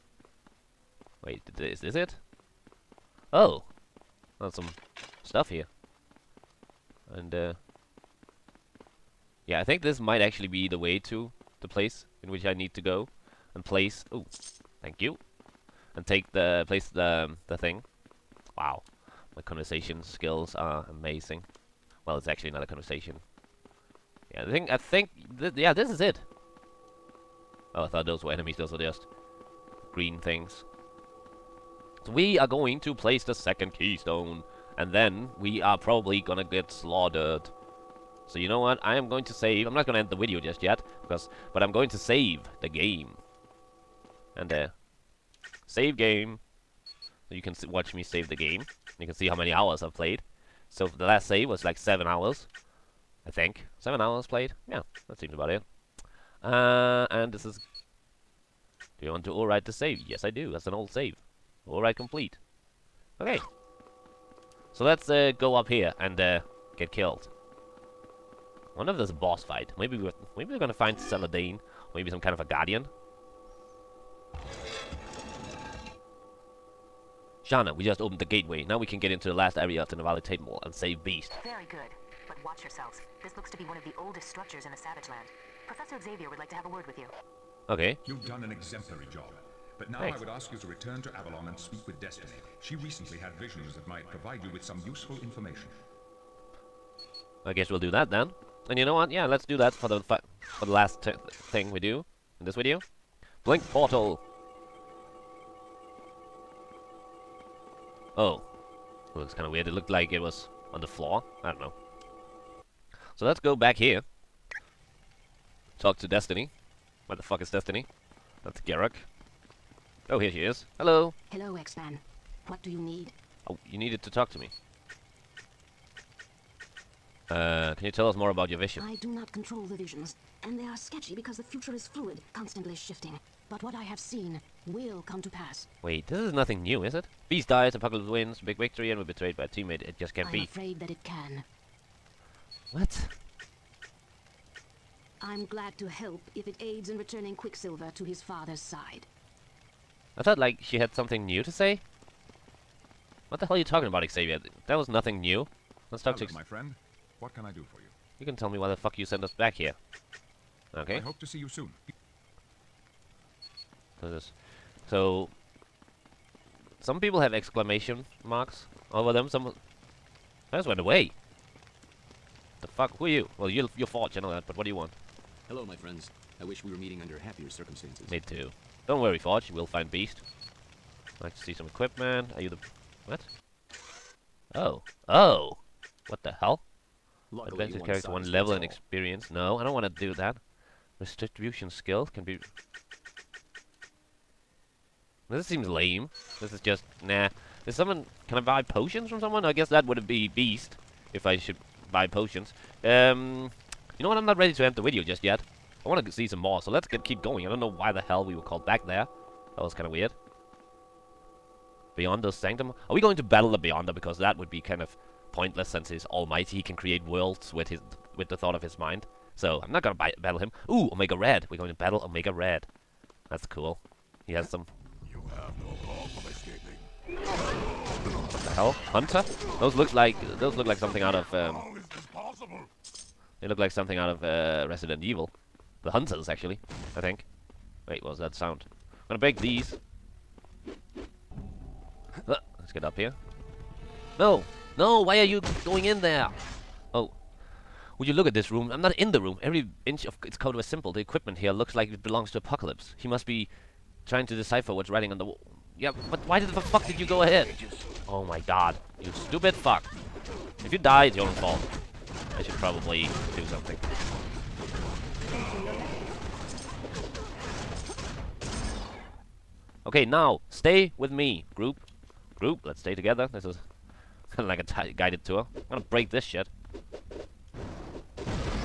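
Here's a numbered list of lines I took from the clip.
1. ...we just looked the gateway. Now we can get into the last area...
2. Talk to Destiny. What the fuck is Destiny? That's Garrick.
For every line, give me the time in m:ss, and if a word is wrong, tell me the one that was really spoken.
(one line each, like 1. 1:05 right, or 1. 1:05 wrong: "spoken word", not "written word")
1. 1:17 wrong: "opened", not "looked"
2. 1:55 right.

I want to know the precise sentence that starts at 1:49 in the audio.
It looked like it was on the floor.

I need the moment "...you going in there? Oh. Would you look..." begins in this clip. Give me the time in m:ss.
4:05.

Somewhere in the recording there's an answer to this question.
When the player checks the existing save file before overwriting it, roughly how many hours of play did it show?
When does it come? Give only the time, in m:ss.
0:53.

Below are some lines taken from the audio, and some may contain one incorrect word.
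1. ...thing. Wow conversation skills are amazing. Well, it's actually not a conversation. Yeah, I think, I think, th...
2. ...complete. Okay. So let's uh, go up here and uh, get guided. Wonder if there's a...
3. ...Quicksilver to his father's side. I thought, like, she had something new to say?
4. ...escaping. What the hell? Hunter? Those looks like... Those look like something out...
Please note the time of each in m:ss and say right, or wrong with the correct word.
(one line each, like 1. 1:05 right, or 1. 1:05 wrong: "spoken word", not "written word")
1. 0:17 right
2. 1:01 wrong: "killed", not "guided"
3. 2:27 right
4. 3:46 right.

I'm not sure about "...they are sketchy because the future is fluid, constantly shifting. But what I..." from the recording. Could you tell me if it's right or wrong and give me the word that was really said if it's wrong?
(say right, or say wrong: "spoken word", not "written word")
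right.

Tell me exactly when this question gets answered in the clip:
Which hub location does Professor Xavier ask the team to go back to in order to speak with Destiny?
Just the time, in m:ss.
1:31.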